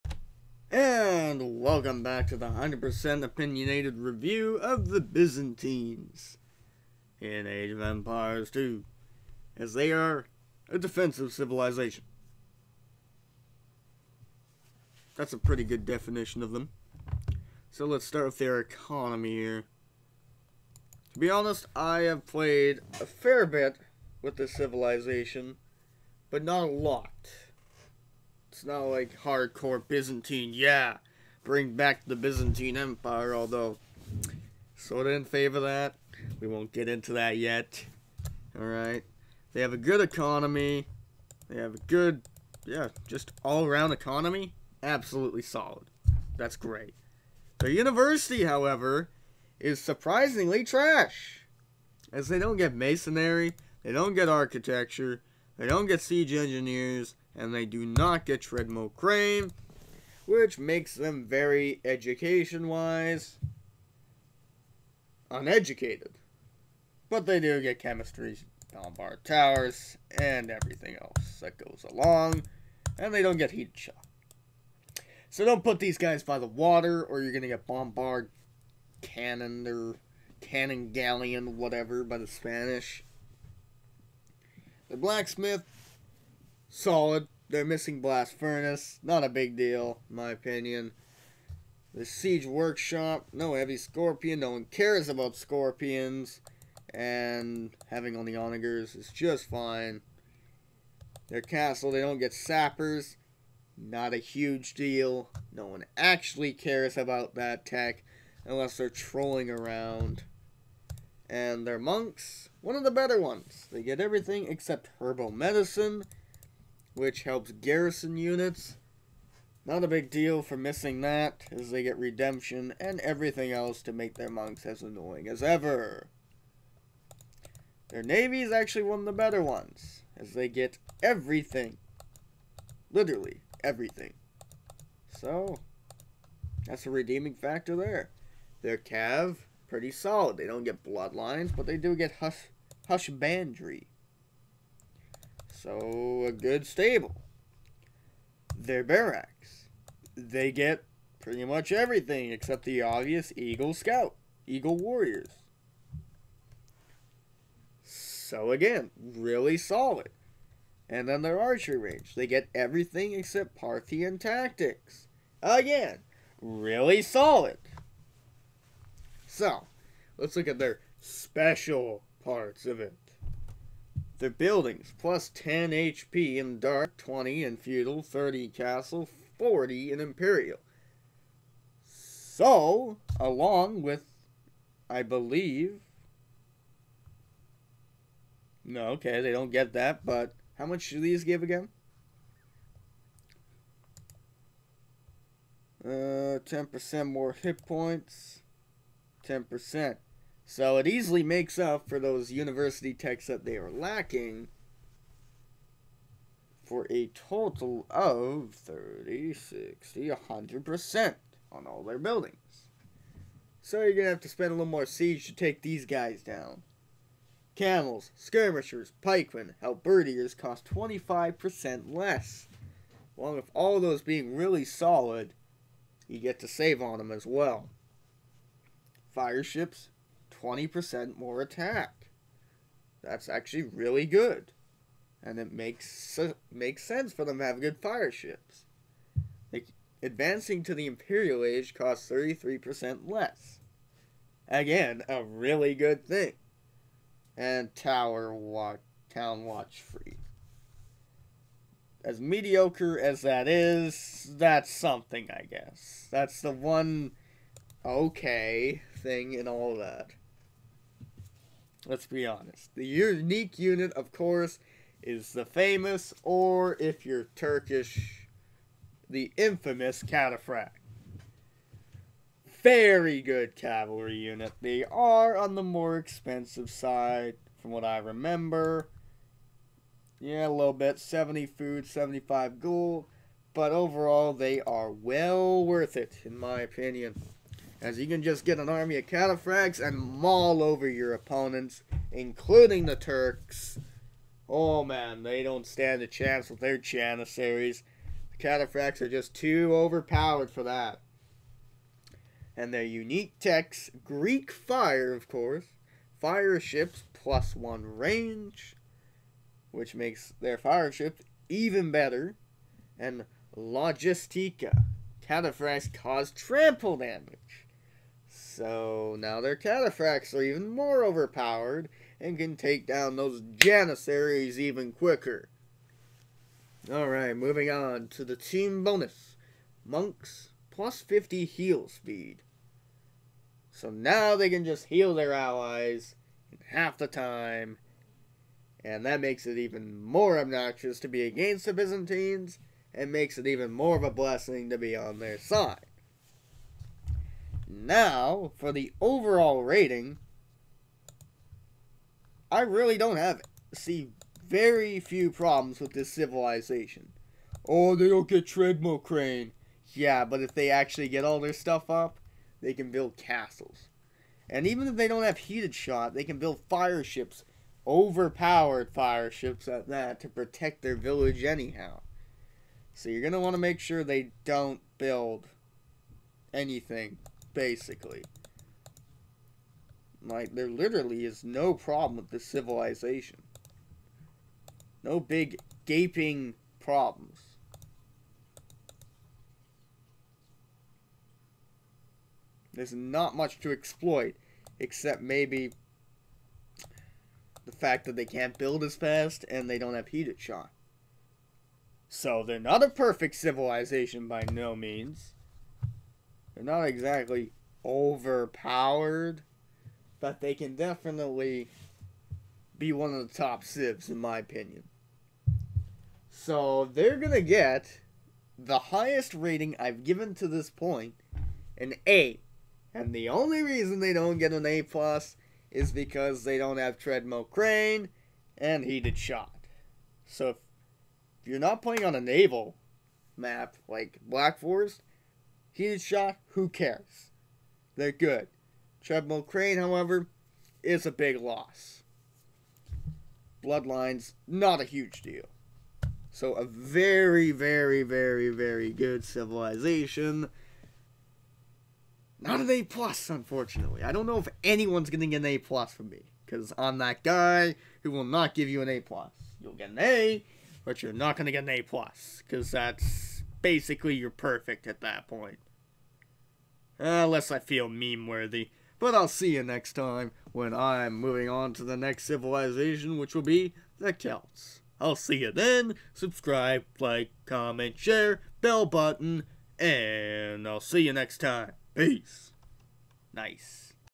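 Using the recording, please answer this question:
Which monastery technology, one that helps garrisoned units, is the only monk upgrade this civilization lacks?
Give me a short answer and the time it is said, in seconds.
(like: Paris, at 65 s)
Herbal medicine, at 115 s.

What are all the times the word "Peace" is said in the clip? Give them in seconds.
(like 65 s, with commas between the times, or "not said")
481 s.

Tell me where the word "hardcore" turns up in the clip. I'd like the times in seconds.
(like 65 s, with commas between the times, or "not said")
29 s.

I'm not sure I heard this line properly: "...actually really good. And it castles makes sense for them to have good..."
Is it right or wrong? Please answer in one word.
wrong.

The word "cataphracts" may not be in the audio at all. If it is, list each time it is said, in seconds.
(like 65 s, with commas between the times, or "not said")
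270 s, 289 s, 298 s, 315 s, 319 s.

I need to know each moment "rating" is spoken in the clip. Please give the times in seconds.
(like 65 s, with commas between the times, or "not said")
349 s, 419 s.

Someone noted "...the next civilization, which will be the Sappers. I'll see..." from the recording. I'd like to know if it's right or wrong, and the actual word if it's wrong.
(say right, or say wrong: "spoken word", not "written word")
wrong: "Celts", not "Sappers".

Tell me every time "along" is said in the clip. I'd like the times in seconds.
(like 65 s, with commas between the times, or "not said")
71 s, 183 s, 223 s.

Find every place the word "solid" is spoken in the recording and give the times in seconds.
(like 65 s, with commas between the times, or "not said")
45 s, 86 s, 139 s, 159 s, 167 s, 224 s.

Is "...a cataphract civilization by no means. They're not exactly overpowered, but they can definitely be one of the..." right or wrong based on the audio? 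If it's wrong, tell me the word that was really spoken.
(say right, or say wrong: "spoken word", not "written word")
wrong: "perfect", not "cataphract".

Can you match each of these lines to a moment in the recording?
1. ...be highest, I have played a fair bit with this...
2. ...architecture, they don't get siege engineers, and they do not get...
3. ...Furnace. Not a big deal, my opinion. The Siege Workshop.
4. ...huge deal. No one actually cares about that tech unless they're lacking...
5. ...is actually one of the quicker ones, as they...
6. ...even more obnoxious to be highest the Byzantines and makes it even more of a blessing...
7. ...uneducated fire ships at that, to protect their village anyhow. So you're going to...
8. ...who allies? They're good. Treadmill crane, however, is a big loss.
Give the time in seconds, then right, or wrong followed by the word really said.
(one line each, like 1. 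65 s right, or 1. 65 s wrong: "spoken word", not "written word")
1. 21 s wrong: "honest", not "highest"
2. 54 s right
3. 88 s right
4. 104 s wrong: "trolling", not "lacking"
5. 128 s wrong: "better", not "quicker"
6. 339 s wrong: "against", not "highest"
7. 367 s wrong: "overpowered", not "uneducated"
8. 436 s wrong: "cares", not "allies".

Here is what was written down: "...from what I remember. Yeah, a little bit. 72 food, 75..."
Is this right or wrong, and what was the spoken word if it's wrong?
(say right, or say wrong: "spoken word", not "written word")
wrong: "70", not "72".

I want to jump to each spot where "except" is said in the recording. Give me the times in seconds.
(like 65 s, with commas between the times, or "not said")
114 s, 152 s, 163 s, 394 s.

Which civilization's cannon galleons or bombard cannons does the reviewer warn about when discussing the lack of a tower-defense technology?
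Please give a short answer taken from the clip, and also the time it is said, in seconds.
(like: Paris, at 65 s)
Spanish, at 82 s.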